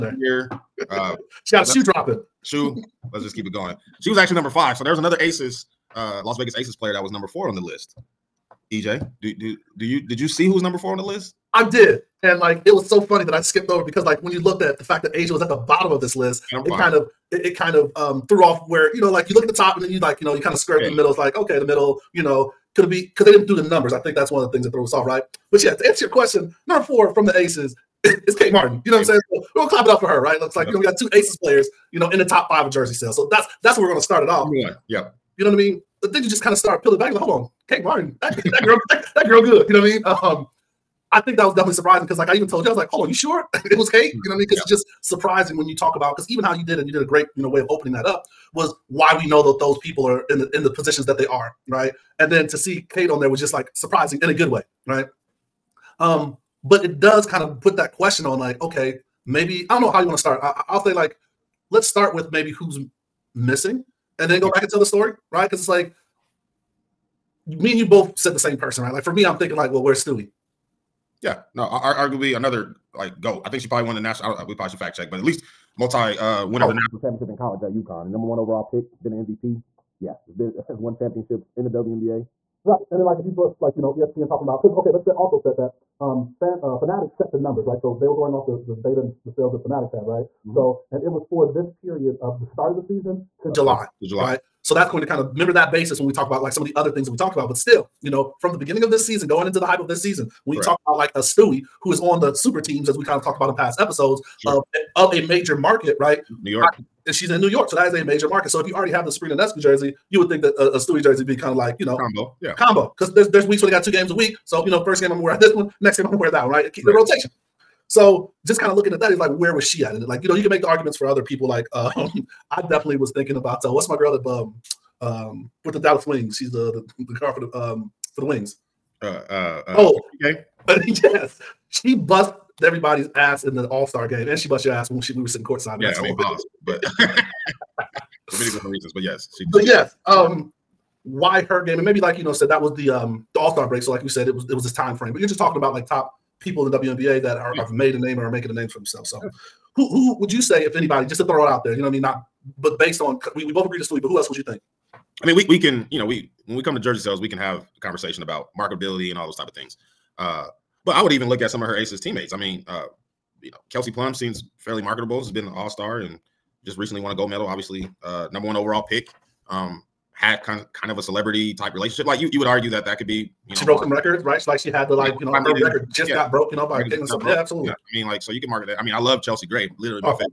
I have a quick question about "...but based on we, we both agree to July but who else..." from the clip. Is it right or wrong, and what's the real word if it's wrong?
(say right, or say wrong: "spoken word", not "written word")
wrong: "Stewie", not "July".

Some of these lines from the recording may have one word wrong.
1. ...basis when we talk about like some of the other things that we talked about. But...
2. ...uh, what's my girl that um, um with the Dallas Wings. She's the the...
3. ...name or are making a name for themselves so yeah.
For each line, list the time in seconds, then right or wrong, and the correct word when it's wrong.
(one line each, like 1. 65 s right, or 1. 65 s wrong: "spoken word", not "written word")
1. 95 s right
2. 123 s right
3. 147 s right.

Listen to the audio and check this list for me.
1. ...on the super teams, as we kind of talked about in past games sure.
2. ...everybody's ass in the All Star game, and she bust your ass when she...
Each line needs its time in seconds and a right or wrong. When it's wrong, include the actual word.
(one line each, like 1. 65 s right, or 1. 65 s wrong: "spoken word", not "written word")
1. 101 s wrong: "episodes", not "games"
2. 132 s right.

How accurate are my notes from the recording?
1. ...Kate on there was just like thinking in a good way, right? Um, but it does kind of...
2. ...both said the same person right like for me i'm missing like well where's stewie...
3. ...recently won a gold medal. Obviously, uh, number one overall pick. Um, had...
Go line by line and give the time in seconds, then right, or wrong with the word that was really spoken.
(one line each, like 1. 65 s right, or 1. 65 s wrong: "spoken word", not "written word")
1. 52 s wrong: "surprising", not "thinking"
2. 67 s wrong: "thinking", not "missing"
3. 166 s right.